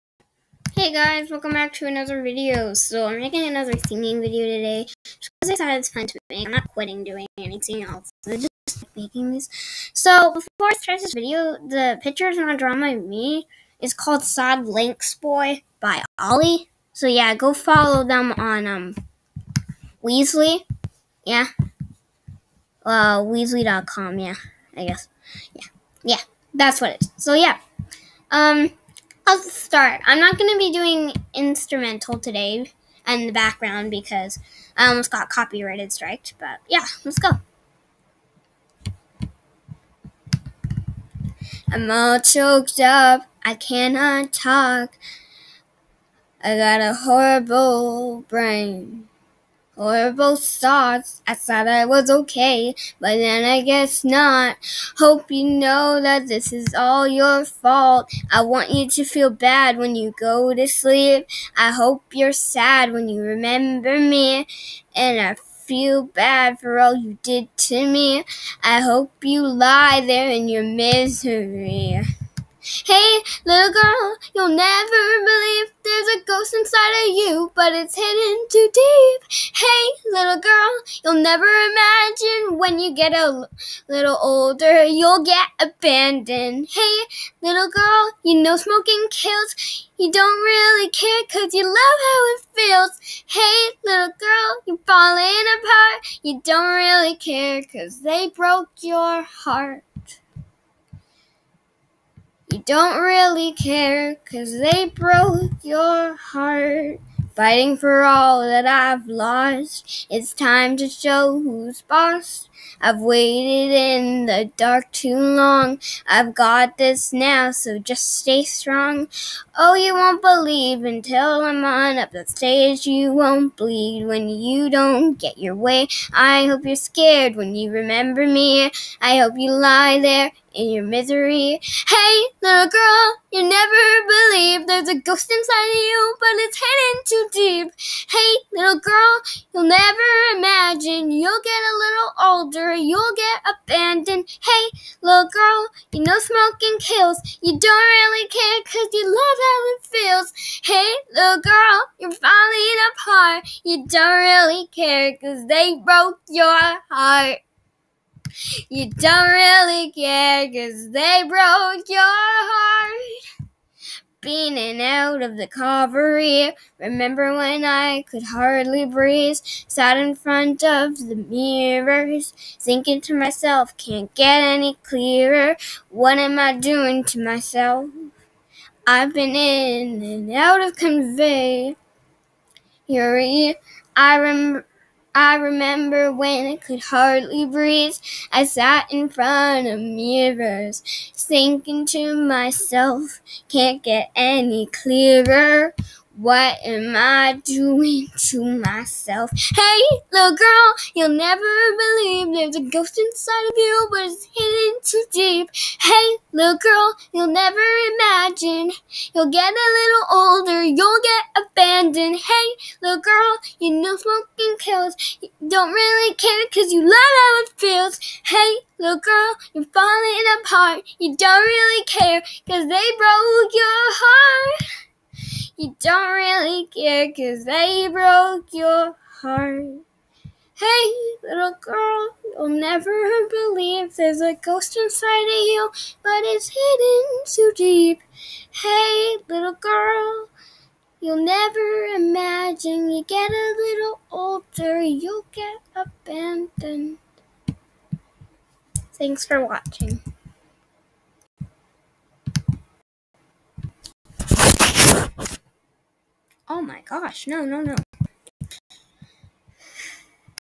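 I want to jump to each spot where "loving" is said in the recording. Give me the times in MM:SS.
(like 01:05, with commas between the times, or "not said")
not said.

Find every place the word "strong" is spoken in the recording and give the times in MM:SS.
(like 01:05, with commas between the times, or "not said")
01:58.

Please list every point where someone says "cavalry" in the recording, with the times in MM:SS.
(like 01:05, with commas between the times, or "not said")
02:45.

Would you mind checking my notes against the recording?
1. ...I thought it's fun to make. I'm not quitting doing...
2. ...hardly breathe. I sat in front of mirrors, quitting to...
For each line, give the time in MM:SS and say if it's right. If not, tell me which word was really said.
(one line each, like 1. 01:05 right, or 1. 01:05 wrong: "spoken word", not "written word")
1. 00:05 right
2. 03:06 wrong: "thinking", not "quitting".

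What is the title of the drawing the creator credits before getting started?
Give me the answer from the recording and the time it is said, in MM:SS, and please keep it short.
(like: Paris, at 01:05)
Sad Links Boy, at 00:14.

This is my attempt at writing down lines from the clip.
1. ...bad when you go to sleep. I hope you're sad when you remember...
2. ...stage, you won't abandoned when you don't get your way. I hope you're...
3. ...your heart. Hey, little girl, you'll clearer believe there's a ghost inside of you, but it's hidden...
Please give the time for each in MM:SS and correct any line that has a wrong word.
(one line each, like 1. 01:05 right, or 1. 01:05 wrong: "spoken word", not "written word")
1. 00:59 right
2. 02:02 wrong: "bleed", not "abandoned"
3. 03:48 wrong: "never", not "clearer".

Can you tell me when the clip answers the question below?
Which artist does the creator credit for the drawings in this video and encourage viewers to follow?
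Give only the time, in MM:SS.
00:16.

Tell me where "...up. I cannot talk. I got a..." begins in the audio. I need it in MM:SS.
00:42.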